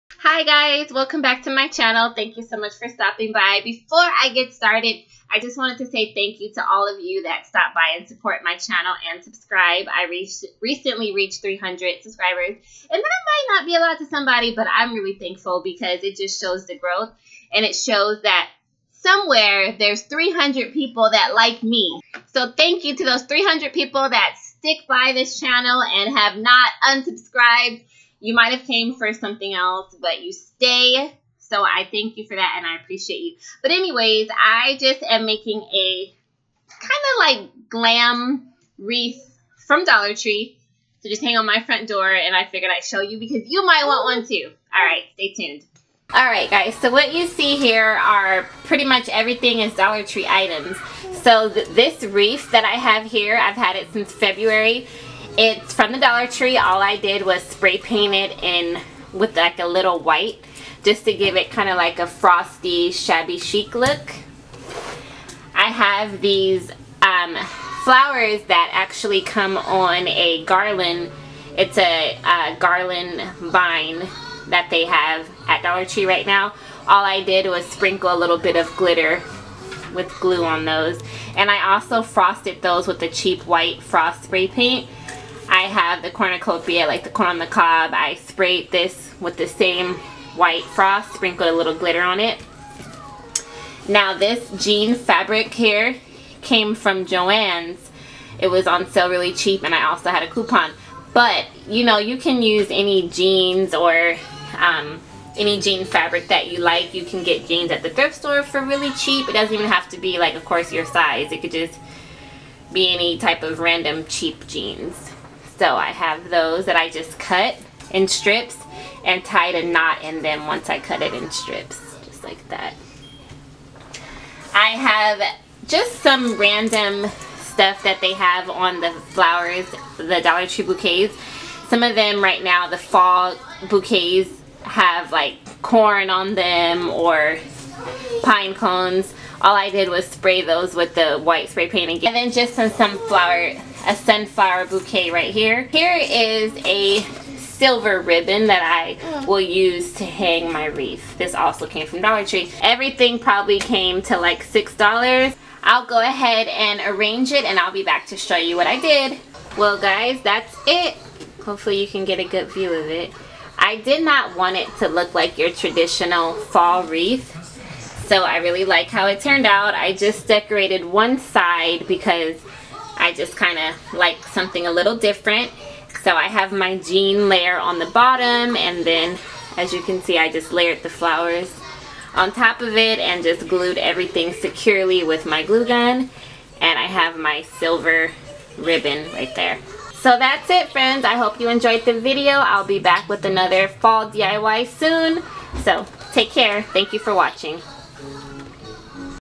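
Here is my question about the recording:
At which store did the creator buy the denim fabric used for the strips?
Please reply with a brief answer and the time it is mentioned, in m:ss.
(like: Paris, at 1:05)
Joann's, at 1:37.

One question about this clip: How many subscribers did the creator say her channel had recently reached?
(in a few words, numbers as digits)
300.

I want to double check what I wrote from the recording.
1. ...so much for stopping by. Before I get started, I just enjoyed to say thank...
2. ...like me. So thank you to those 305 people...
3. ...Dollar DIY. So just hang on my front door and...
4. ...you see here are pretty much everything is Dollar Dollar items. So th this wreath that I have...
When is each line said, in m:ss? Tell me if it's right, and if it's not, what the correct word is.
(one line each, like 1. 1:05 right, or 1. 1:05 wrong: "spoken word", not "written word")
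1. 0:02 wrong: "wanted", not "enjoyed"
2. 0:21 wrong: "300", not "305"
3. 0:39 wrong: "Tree", not "DIY"
4. 0:47 wrong: "Tree", not "Dollar".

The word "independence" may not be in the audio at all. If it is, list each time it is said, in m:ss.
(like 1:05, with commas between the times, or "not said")
not said.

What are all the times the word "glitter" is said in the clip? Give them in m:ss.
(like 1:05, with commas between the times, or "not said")
1:18, 1:31.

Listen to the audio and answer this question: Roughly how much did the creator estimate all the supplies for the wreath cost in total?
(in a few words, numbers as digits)
$6.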